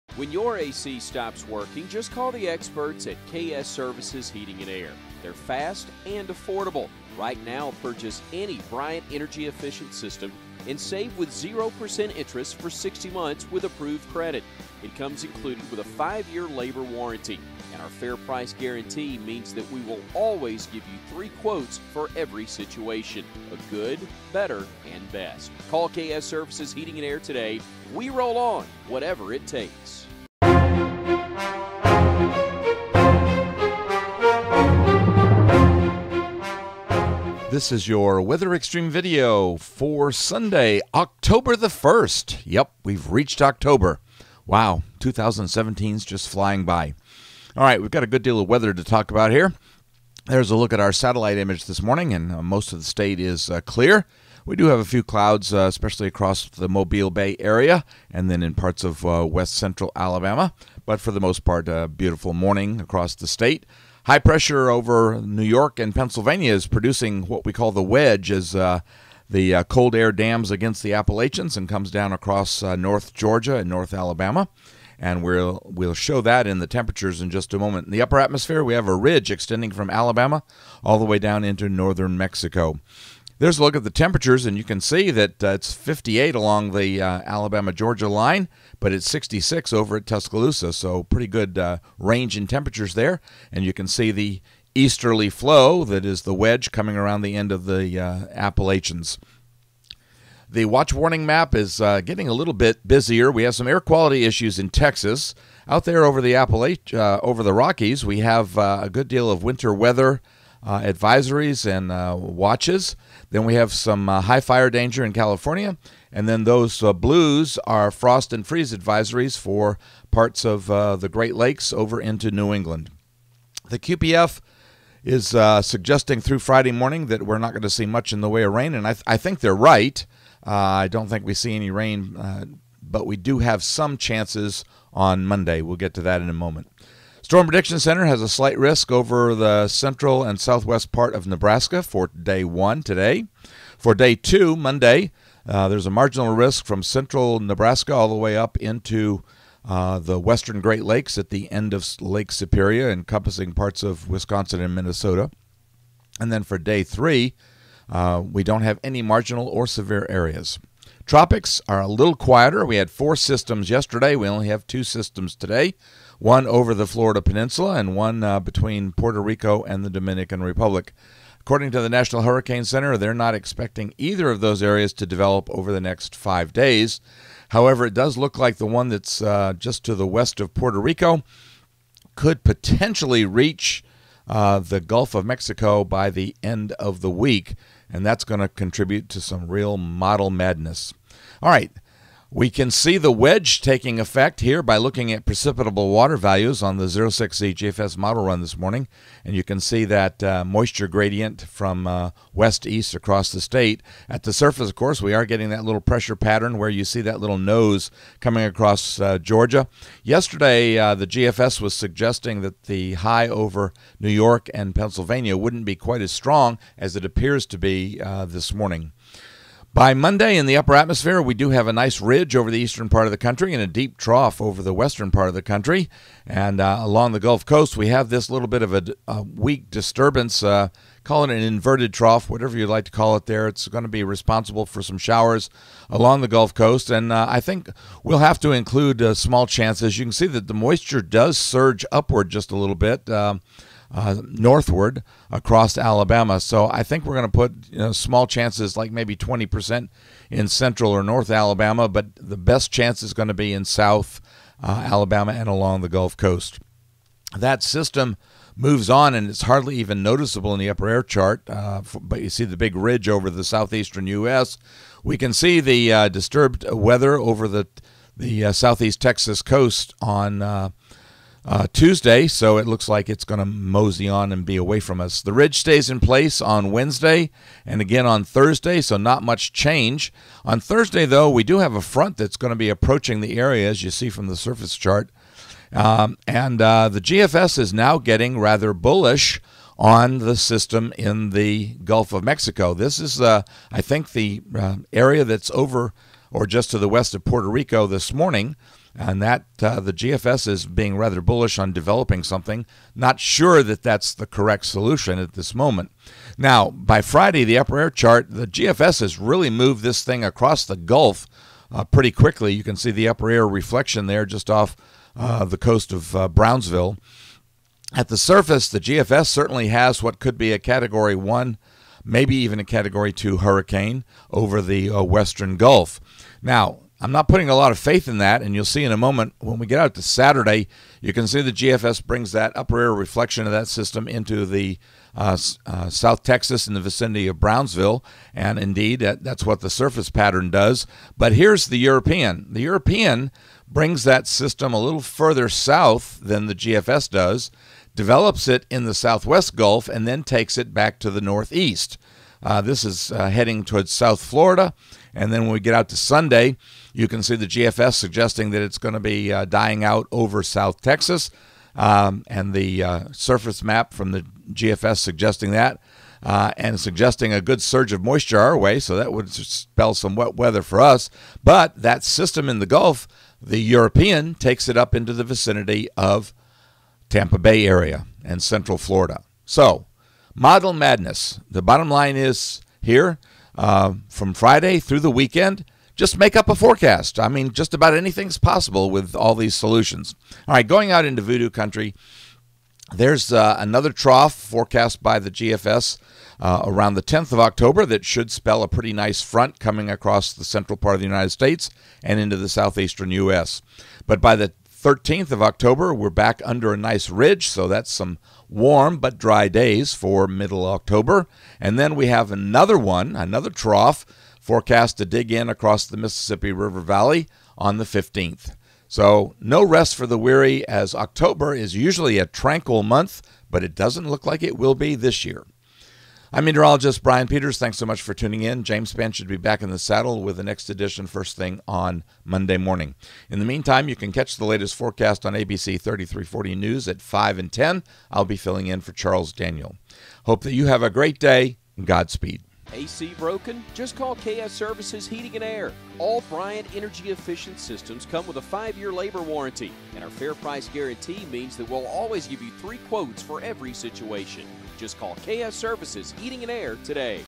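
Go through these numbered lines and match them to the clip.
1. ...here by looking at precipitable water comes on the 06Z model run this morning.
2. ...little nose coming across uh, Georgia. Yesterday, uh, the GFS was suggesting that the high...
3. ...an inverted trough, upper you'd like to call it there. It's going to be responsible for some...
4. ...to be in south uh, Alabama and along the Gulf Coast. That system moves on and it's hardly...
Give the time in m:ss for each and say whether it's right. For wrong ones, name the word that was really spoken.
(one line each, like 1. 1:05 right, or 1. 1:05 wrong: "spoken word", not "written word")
1. 3:14 wrong: "values", not "comes"
2. 3:27 right
3. 3:51 wrong: "whatever", not "upper"
4. 4:13 right.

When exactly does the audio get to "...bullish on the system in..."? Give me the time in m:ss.
4:48.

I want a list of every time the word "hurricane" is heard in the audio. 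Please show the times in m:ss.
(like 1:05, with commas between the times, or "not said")
2:52, 5:23.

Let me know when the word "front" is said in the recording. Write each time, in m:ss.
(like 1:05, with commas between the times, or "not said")
4:41, 6:39.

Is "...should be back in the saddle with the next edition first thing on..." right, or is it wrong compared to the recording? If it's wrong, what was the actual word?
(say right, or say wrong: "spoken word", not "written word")
right.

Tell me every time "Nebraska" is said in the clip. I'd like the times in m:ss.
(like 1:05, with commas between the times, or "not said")
2:21, 2:27.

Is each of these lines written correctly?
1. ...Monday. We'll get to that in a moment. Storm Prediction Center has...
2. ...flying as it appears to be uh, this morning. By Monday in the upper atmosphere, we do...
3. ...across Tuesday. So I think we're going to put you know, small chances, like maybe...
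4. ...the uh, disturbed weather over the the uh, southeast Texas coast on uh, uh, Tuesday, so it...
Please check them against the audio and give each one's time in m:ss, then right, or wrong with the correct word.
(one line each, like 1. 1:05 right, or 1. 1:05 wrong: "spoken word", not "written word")
1. 2:15 right
2. 3:36 wrong: "strong", not "flying"
3. 4:05 wrong: "Alabama", not "Tuesday"
4. 4:25 right.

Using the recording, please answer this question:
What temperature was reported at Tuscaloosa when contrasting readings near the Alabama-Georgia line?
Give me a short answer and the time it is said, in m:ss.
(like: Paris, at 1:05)
66, at 1:29.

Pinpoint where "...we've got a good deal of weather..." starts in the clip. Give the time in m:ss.
0:47.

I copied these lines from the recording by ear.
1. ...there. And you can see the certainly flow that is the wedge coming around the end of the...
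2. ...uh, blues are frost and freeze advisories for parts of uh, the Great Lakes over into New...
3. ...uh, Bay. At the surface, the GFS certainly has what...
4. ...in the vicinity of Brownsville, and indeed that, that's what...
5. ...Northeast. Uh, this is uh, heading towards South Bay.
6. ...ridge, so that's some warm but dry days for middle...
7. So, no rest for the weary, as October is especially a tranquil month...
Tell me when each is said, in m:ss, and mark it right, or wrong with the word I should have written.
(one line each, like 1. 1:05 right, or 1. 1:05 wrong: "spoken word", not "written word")
1. 1:32 wrong: "easterly", not "certainly"
2. 1:56 right
3. 5:16 wrong: "Brownsville", not "Bay"
4. 5:36 right
5. 5:51 wrong: "Florida", not "Bay"
6. 6:47 right
7. 6:58 wrong: "usually", not "especially".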